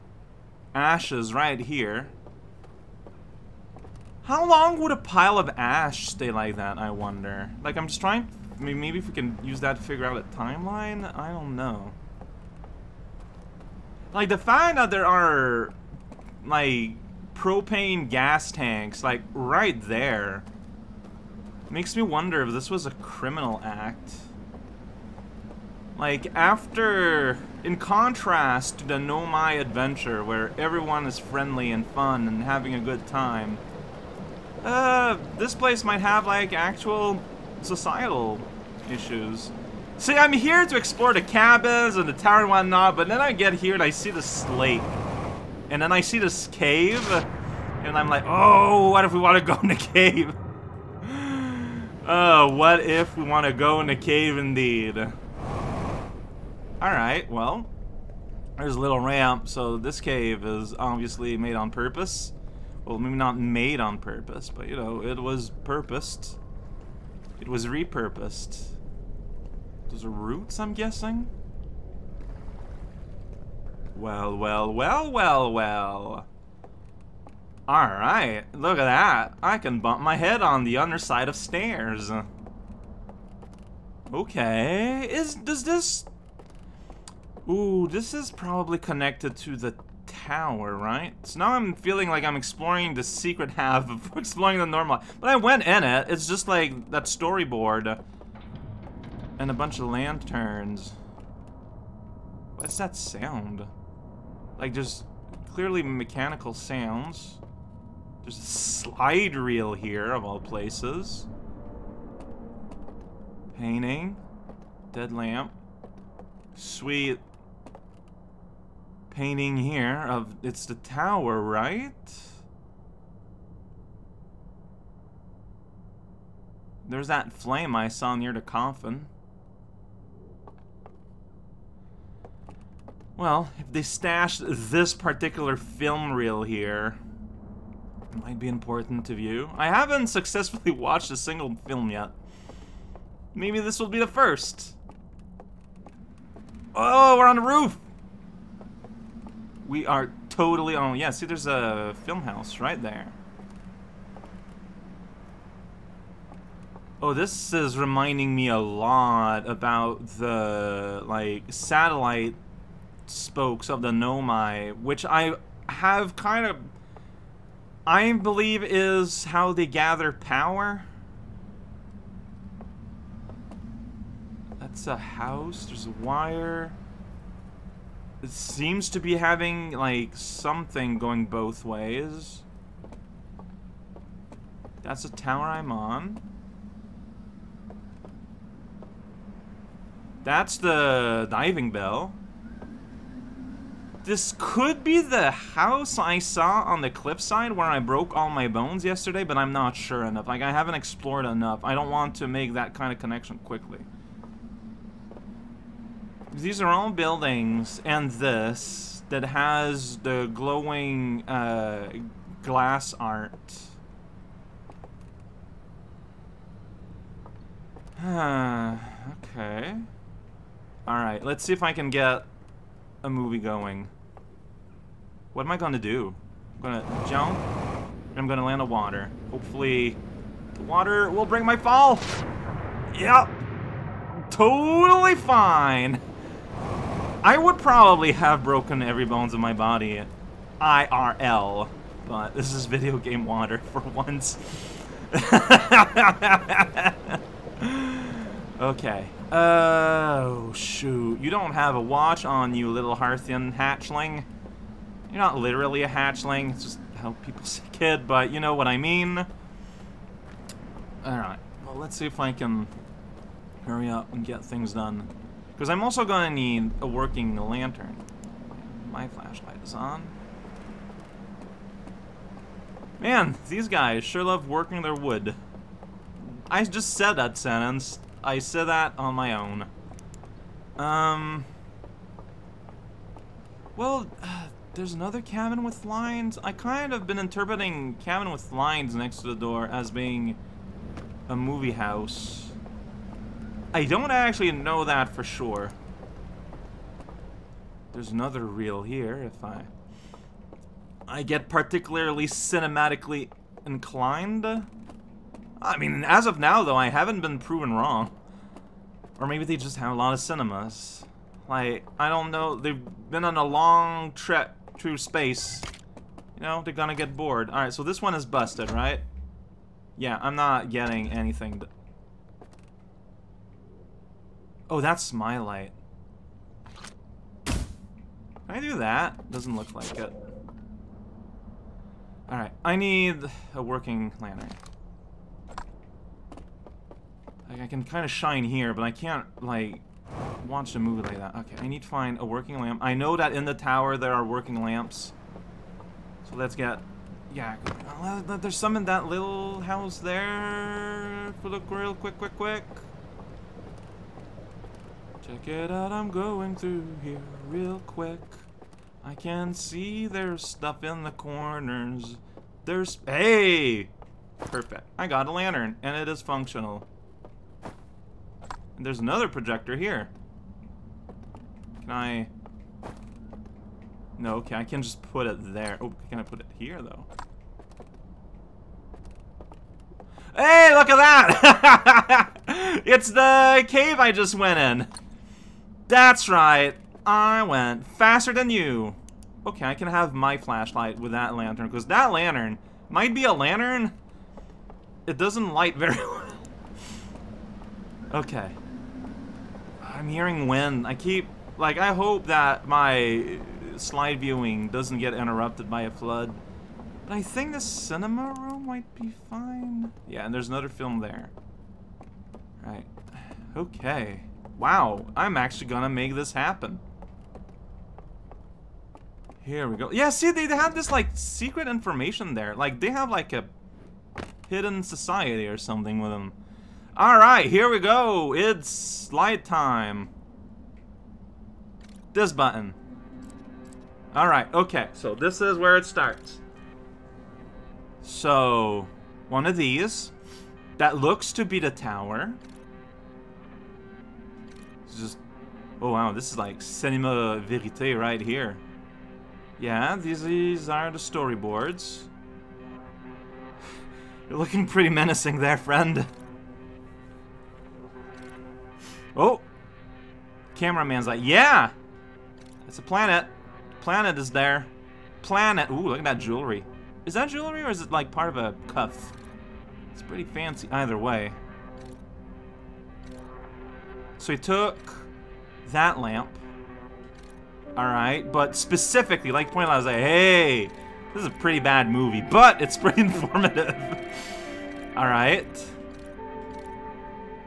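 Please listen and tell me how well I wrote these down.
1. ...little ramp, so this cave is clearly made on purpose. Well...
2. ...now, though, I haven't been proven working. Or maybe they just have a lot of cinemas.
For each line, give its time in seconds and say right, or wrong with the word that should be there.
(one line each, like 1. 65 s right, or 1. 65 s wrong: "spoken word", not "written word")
1. 58 s wrong: "obviously", not "clearly"
2. 306 s wrong: "wrong", not "working".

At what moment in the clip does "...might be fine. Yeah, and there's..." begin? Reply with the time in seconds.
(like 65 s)
408 s.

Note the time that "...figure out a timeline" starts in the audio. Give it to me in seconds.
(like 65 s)
9 s.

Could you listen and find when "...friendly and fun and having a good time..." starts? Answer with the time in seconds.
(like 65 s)
31 s.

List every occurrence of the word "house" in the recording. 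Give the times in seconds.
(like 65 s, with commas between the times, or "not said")
152 s, 174 s, 195 s, 291 s, 349 s.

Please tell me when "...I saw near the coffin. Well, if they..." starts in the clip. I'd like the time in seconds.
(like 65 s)
127 s.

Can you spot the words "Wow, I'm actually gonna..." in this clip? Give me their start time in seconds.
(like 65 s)
414 s.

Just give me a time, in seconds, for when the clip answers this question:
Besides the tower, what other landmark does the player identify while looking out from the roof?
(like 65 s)
191 s.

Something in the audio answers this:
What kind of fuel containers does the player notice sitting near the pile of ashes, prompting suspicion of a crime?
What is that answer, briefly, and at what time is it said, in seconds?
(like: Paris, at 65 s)
propane gas tanks, at 17 s.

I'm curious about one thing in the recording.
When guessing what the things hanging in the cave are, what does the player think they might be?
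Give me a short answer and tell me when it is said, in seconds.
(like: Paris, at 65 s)
roots, at 70 s.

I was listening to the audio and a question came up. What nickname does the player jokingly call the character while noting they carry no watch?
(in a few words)
little Hearthian hatchling.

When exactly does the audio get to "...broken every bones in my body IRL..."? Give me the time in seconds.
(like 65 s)
238 s.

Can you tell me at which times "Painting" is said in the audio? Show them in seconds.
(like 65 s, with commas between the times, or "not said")
113 s, 119 s.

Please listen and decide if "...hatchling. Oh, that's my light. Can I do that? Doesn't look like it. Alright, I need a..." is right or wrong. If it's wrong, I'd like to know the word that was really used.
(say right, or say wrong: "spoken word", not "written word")
wrong: "anything", not "hatchling".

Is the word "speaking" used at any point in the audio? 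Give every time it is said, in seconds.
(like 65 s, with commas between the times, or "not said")
not said.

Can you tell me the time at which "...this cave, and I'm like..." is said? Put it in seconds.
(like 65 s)
46 s.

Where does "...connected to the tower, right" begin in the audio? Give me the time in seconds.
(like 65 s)
88 s.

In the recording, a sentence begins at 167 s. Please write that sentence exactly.
I believe is how they gather power.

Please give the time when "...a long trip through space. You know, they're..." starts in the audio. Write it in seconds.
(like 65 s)
313 s.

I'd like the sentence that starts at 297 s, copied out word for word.
There's another reel here if I...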